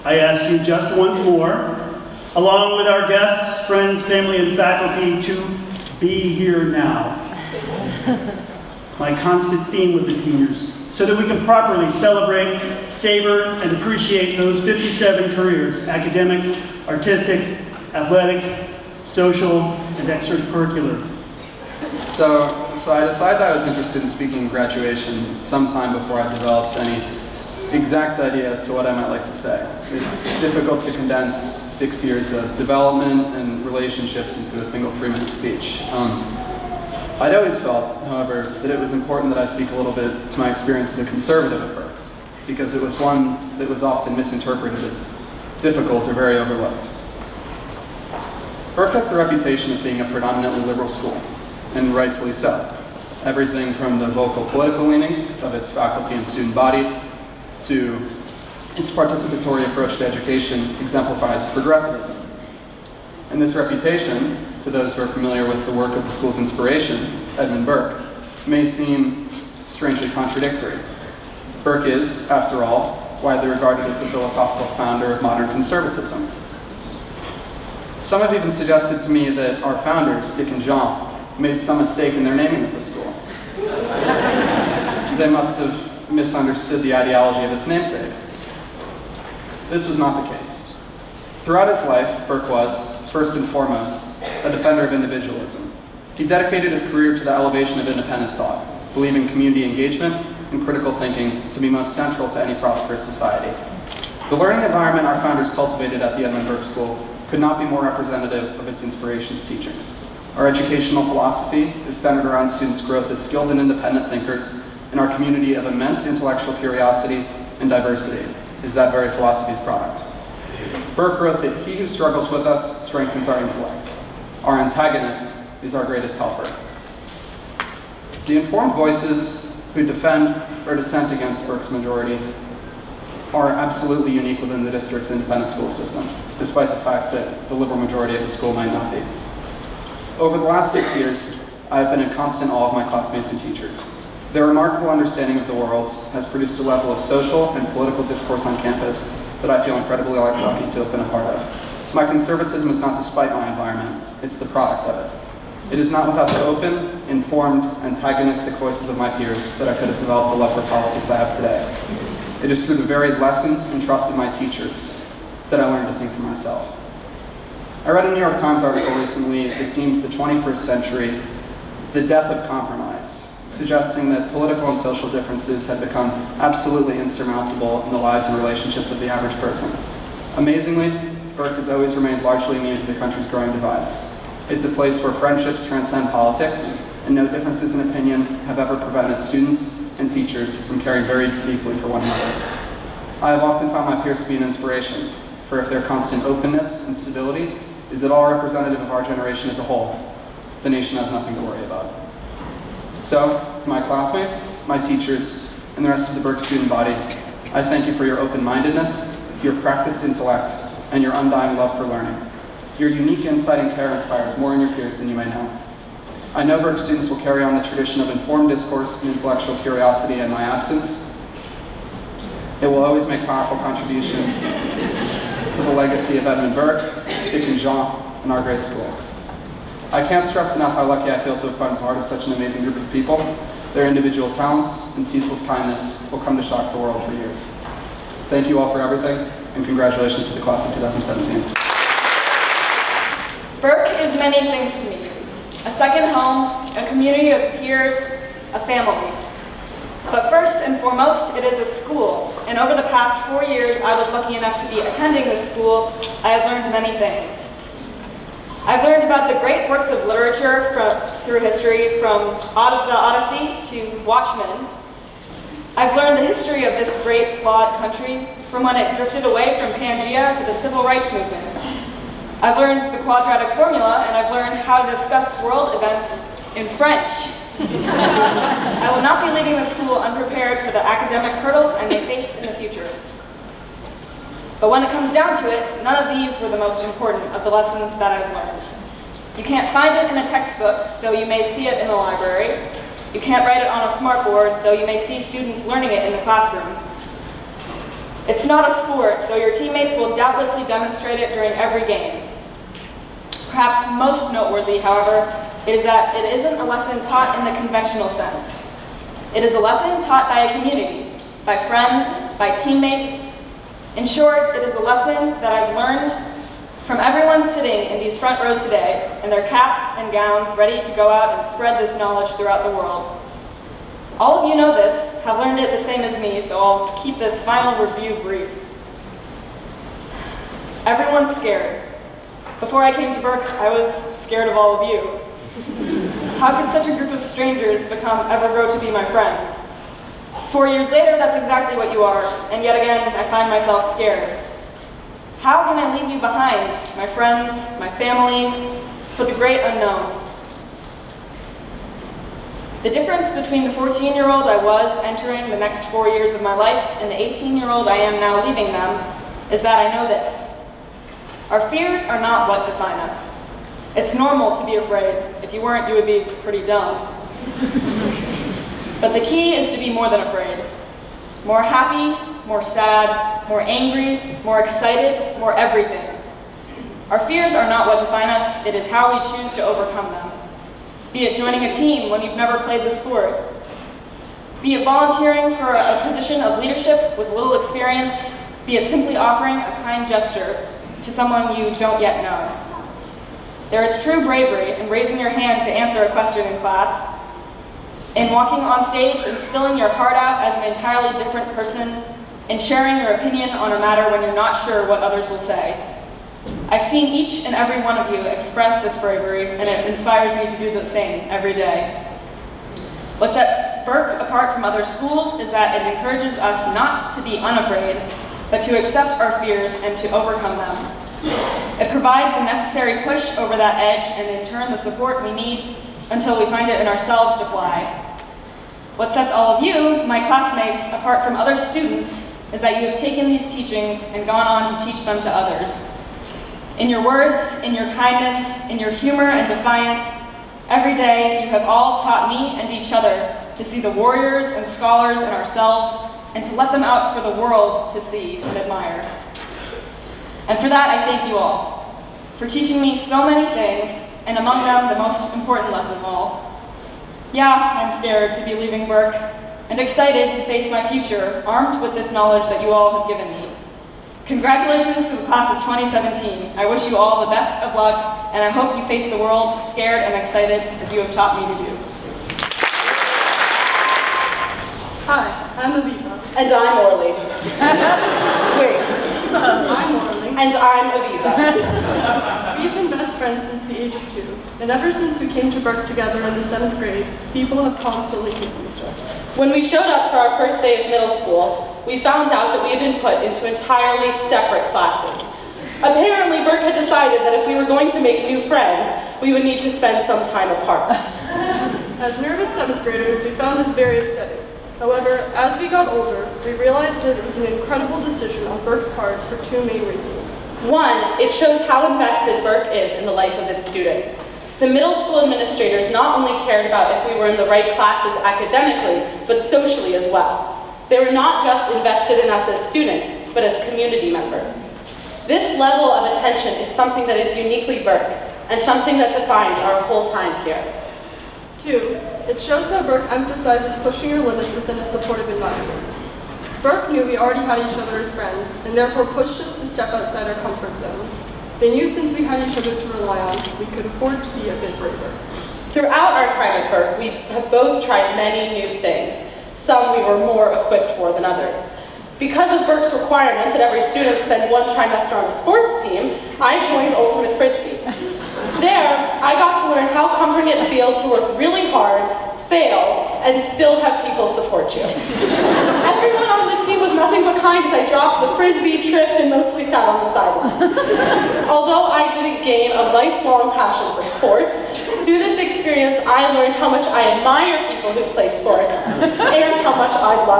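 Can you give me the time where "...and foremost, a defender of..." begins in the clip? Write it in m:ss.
1:33.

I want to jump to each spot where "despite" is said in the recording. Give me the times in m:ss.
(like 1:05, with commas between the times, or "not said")
2:16, 2:32.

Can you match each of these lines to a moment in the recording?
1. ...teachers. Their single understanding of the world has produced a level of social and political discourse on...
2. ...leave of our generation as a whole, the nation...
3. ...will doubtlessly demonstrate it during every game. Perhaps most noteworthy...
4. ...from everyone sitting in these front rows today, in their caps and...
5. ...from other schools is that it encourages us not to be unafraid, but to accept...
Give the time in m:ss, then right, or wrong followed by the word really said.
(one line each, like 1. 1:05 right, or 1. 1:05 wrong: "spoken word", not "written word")
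1. 2:23 wrong: "remarkable", not "single"
2. 3:18 wrong: "representative", not "leave"
3. 4:59 right
4. 5:16 right
5. 6:54 right.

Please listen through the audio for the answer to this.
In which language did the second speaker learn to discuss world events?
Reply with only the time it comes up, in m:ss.
4:36.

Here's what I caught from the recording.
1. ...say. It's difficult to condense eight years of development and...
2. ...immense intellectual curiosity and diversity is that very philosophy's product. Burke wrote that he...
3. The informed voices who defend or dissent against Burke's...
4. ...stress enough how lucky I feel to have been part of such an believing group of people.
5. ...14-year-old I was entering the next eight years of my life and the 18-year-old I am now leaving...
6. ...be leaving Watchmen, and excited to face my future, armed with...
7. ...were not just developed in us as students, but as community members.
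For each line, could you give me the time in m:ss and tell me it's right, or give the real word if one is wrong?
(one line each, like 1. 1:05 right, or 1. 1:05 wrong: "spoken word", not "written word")
1. 0:29 wrong: "six", not "eight"
2. 1:55 right
3. 2:08 right
4. 3:50 wrong: "amazing", not "believing"
5. 5:53 wrong: "four", not "eight"
6. 7:38 wrong: "Burke", not "Watchmen"
7. 8:40 wrong: "invested", not "developed".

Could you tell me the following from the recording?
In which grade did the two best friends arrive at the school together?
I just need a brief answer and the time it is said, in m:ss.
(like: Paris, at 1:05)
seventh grade, at 8:06.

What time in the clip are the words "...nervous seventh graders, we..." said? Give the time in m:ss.
8:22.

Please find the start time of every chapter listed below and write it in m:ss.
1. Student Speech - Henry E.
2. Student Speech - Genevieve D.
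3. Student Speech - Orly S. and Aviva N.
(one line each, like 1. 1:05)
1. 0:21
2. 4:02
3. 7:54.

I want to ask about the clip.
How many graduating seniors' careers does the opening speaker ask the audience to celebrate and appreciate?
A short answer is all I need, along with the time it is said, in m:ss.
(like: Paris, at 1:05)
57, at 0:14.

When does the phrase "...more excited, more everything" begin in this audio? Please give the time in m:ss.
6:14.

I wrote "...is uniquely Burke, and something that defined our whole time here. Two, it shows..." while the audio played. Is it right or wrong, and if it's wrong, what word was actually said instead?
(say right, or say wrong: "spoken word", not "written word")
right.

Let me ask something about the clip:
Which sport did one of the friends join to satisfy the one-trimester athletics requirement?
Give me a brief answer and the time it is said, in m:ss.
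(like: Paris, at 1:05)
Ultimate Frisbee, at 9:16.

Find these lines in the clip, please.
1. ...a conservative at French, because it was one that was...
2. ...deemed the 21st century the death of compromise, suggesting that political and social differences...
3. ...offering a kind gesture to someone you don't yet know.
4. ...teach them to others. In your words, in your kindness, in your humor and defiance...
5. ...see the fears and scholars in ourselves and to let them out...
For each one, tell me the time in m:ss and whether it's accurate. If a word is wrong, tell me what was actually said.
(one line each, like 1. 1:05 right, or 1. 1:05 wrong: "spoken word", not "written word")
1. 0:40 wrong: "Burke", not "French"
2. 2:49 right
3. 6:29 right
4. 7:14 right
5. 7:23 wrong: "warriors", not "fears".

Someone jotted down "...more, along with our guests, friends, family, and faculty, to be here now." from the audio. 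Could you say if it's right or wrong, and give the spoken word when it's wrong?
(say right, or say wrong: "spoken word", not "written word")
right.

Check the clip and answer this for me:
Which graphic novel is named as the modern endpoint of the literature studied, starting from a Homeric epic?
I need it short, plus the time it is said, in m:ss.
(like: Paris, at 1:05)
Watchmen, at 4:24.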